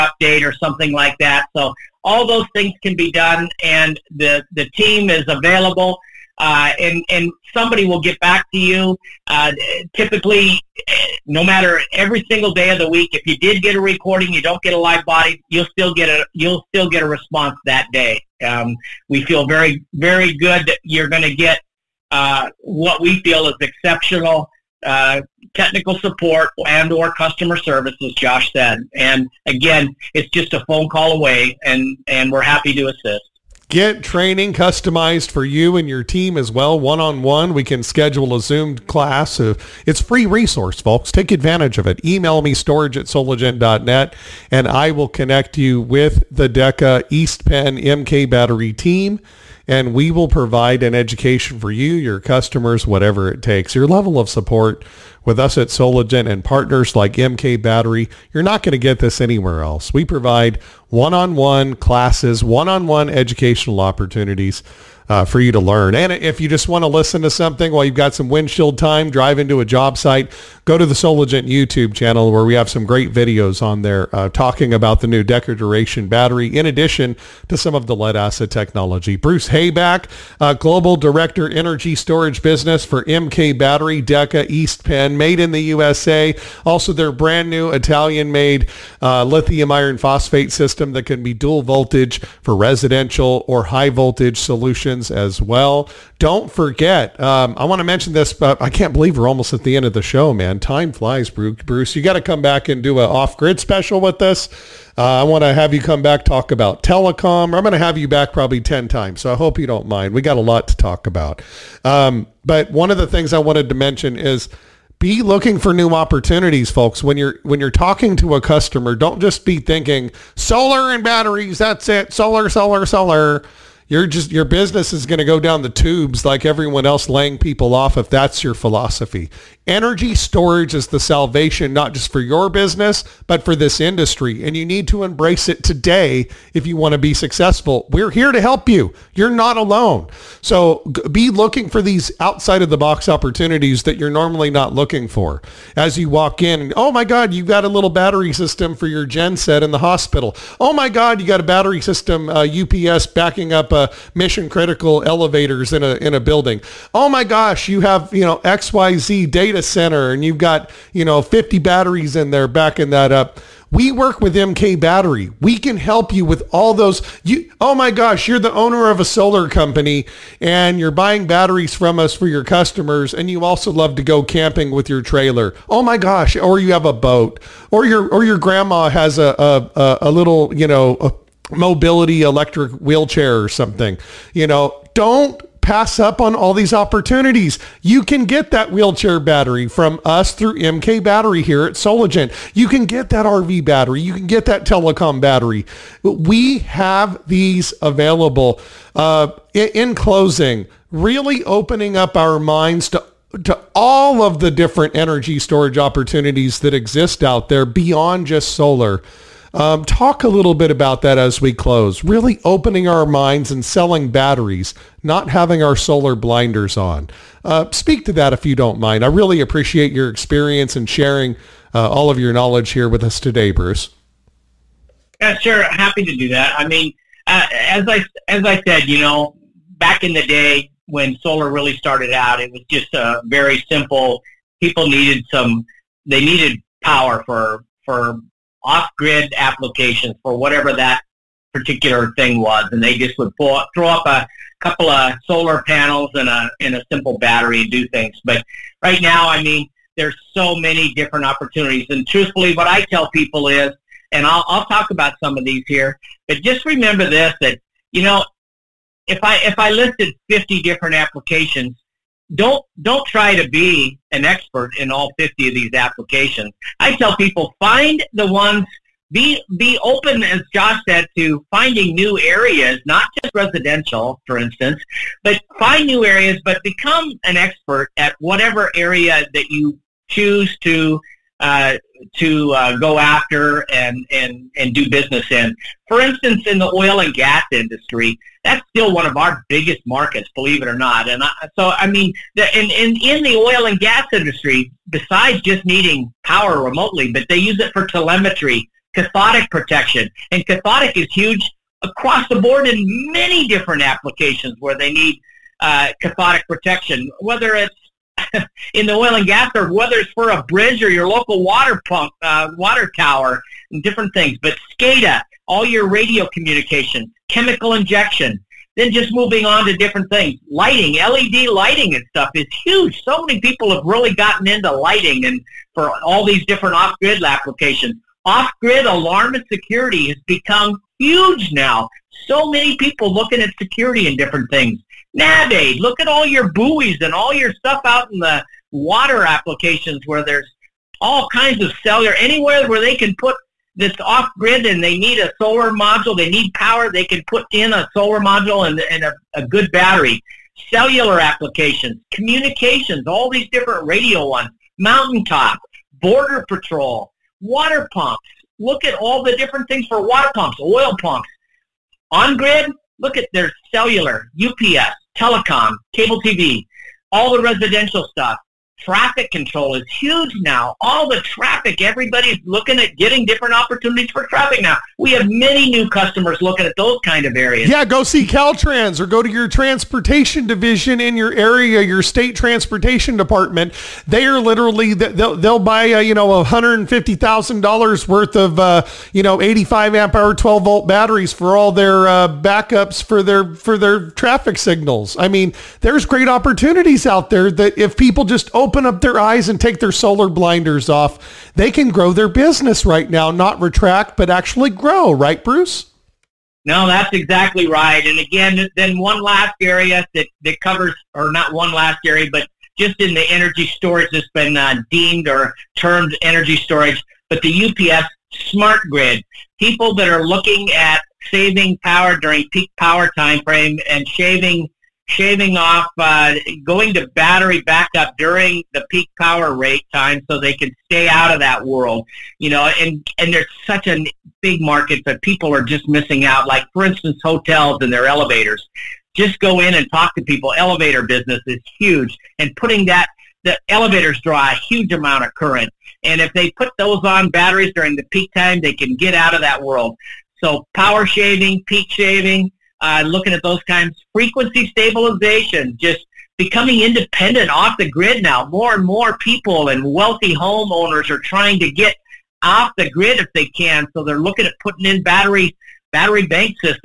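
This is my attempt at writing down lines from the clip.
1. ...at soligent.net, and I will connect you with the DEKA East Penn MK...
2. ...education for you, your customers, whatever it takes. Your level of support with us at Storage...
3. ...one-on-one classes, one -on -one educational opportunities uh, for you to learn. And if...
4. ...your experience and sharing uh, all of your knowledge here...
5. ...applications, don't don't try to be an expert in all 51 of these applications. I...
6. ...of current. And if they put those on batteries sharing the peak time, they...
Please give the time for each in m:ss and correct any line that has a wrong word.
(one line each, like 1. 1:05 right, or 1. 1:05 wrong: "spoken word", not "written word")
1. 0:42 right
2. 0:50 wrong: "Soligent", not "Storage"
3. 1:00 right
4. 3:39 right
5. 4:20 wrong: "50", not "51"
6. 7:25 wrong: "during", not "sharing".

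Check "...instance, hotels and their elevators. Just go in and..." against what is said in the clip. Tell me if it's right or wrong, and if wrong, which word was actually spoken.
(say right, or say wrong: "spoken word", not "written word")
right.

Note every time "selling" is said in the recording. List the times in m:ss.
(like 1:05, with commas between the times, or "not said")
3:33.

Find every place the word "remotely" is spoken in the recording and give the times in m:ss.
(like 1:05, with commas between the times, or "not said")
4:56.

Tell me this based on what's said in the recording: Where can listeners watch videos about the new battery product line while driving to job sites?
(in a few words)
Soligent YouTube channel.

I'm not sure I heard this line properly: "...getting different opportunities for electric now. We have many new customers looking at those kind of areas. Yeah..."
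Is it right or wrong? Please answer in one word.
wrong.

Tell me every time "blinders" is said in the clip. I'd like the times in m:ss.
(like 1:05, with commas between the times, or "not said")
3:36, 6:40.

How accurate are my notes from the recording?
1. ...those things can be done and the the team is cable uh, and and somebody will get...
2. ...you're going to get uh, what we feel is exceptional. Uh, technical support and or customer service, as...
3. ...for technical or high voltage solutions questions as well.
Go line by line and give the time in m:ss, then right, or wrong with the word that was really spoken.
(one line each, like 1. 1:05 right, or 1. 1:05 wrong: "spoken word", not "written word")
1. 0:02 wrong: "available", not "cable"
2. 0:20 right
3. 1:32 wrong: "residential", not "technical".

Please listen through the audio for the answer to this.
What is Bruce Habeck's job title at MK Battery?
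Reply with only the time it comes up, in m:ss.
1:20.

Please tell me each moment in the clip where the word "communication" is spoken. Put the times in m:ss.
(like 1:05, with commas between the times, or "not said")
5:16, 5:52.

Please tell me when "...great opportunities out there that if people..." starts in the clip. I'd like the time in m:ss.
6:36.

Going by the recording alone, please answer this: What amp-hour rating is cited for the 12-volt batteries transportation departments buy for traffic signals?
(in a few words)
85 amp hour.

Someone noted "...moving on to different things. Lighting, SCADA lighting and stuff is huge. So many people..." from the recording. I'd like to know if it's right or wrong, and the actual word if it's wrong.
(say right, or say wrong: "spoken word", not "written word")
wrong: "LED", not "SCADA".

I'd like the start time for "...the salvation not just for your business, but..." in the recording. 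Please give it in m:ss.
2:10.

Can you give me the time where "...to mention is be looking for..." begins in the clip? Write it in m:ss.
1:53.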